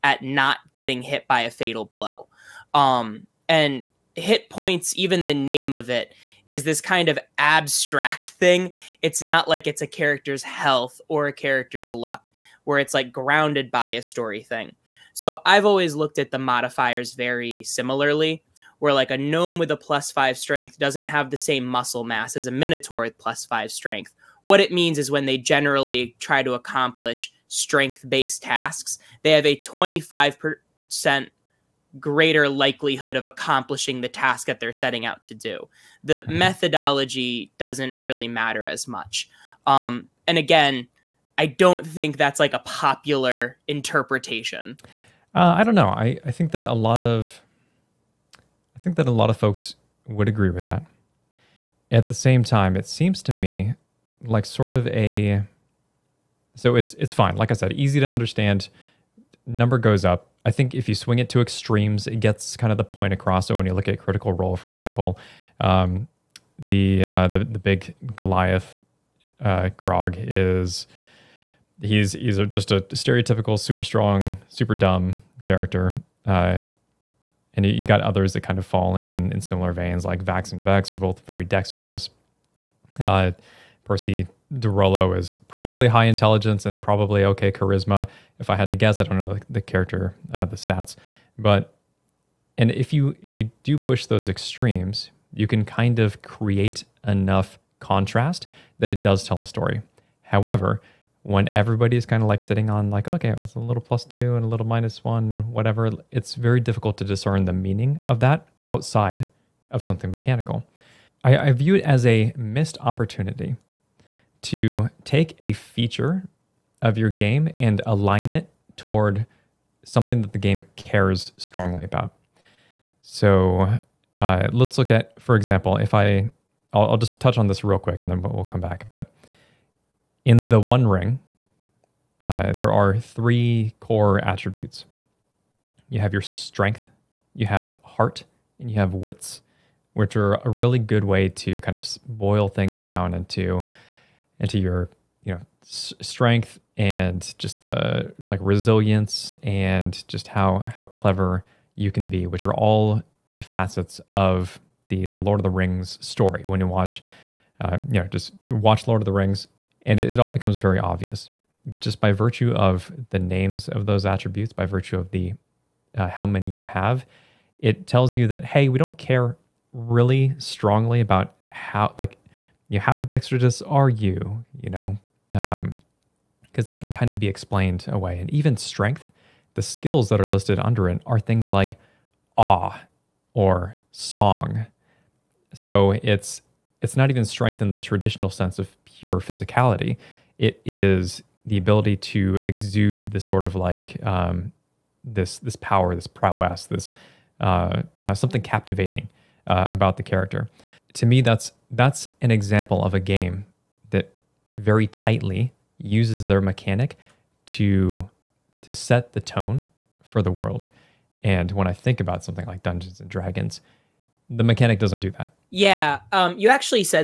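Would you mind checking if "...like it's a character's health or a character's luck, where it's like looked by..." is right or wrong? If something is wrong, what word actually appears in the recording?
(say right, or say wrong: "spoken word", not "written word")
wrong: "grounded", not "looked".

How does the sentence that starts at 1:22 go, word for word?
Uh, Percy de Rolo is probably high intelligence and probably okay charisma.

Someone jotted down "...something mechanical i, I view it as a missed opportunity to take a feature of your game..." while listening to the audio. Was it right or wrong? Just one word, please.
right.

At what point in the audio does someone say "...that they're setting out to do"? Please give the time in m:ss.
0:34.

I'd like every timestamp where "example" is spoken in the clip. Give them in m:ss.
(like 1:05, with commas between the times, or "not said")
1:04, 2:05, 3:22.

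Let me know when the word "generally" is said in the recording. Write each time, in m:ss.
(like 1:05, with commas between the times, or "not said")
0:25.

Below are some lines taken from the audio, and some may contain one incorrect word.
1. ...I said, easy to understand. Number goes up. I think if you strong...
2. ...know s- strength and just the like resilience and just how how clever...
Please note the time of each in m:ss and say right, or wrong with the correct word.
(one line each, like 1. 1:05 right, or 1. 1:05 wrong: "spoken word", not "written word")
1. 0:57 wrong: "swing", not "strong"
2. 2:25 right.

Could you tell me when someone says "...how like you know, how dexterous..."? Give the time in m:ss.
2:51.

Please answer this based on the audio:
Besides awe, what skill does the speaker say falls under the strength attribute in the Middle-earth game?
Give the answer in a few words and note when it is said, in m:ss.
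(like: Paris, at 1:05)
Song, at 3:03.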